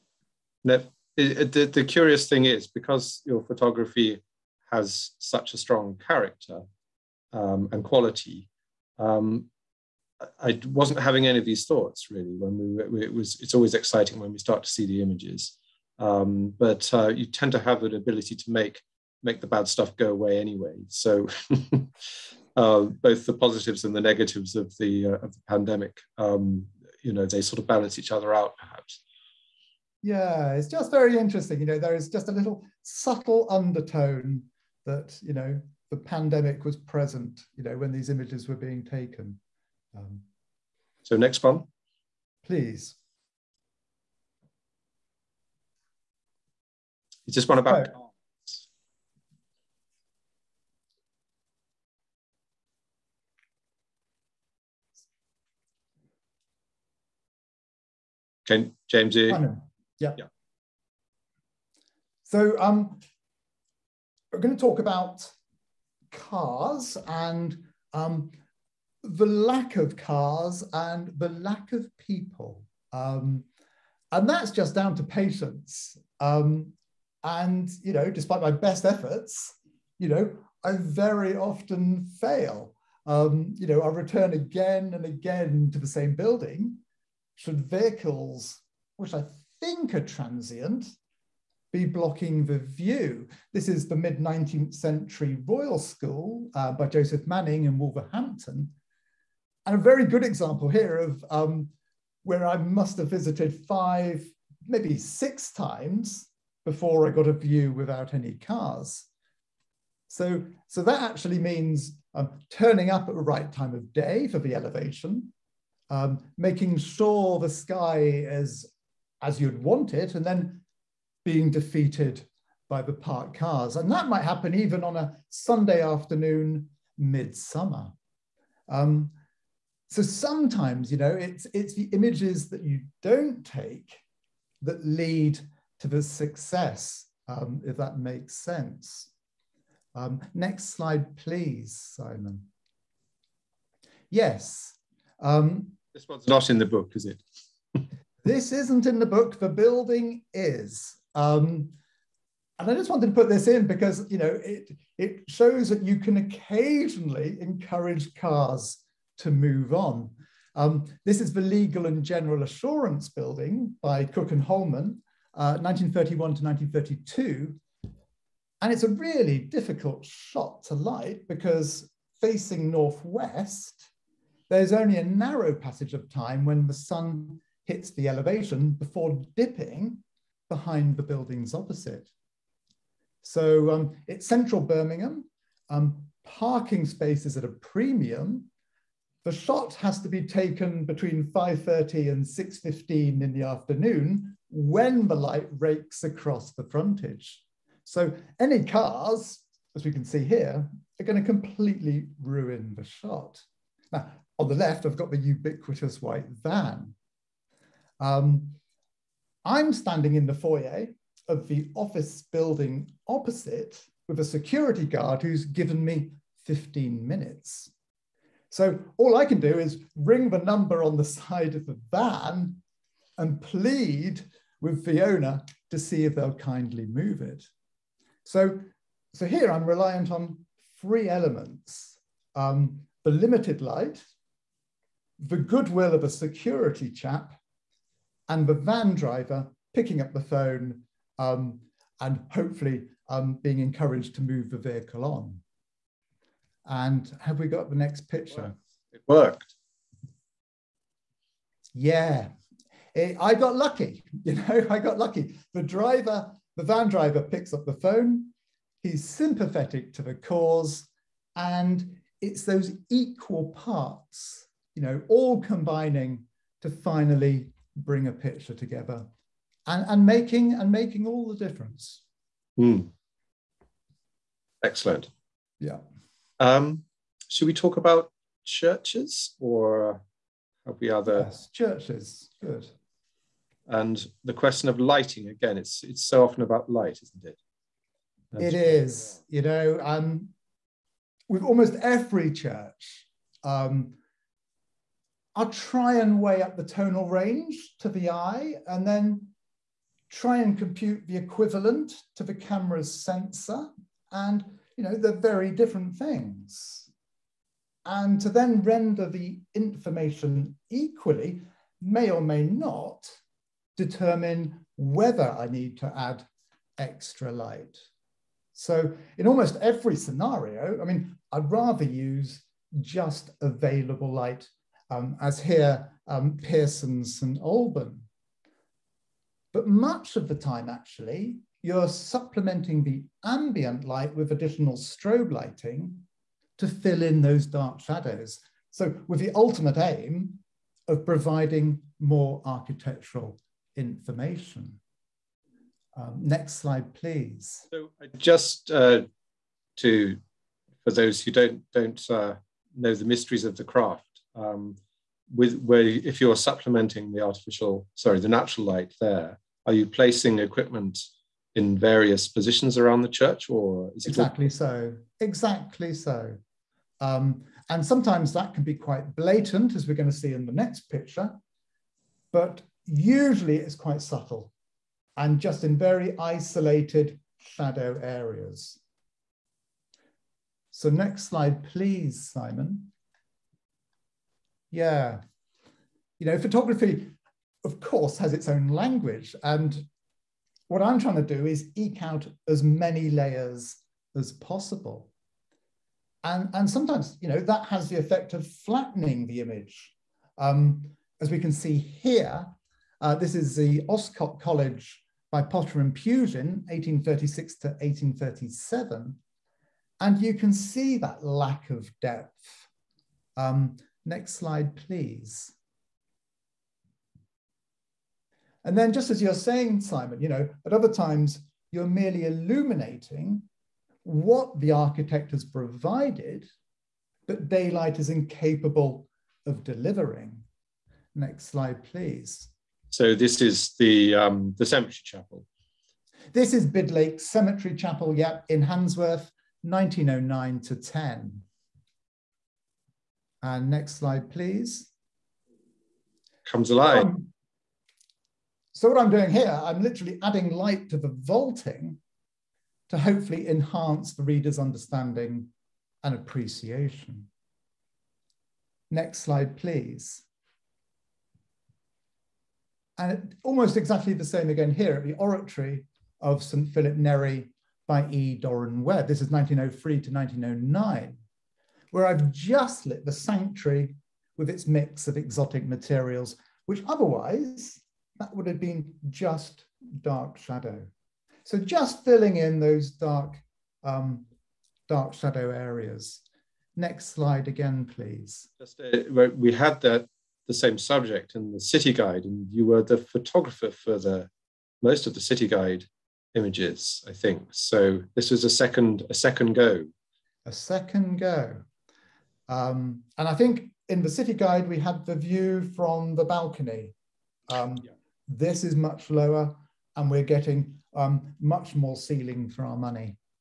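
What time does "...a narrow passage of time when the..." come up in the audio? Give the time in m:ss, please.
2:54.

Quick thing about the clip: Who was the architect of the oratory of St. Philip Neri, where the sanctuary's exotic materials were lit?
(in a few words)
E. Doran Webb.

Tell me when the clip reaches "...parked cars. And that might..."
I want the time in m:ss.
2:02.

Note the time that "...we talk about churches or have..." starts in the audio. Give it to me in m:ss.
4:37.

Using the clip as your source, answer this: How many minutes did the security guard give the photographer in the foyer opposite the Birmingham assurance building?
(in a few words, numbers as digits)
15.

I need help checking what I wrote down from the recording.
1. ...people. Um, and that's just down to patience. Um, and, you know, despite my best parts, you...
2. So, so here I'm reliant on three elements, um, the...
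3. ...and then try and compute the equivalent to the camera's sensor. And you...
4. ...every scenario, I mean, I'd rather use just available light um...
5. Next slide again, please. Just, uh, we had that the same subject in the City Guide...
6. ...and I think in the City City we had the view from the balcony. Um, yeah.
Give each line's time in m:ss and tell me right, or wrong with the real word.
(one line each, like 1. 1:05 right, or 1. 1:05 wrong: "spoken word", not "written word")
1. 1:11 wrong: "efforts", not "parts"
2. 3:48 right
3. 4:58 right
4. 5:19 right
5. 8:06 right
6. 8:23 wrong: "Guide", not "City".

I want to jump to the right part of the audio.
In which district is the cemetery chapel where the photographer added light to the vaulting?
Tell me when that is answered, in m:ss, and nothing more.
7:18.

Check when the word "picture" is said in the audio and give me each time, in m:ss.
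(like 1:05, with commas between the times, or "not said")
4:08, 4:28, 6:10.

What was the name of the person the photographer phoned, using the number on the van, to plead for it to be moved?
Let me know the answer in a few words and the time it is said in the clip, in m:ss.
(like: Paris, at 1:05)
Fiona, at 3:44.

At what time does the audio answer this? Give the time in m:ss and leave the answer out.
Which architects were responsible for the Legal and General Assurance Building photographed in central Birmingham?
2:44.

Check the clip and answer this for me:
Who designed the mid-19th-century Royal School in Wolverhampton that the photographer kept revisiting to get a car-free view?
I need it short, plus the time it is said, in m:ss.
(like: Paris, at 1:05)
Joseph Manning, at 1:36.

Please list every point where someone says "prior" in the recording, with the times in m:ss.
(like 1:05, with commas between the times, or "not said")
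not said.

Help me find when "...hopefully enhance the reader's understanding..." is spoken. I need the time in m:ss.
7:32.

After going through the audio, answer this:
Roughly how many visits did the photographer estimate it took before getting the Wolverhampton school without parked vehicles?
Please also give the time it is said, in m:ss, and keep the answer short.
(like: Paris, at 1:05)
5 or 6, at 1:43.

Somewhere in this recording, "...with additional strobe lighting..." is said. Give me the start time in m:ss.
5:34.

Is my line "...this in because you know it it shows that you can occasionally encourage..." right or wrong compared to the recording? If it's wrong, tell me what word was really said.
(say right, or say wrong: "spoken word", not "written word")
right.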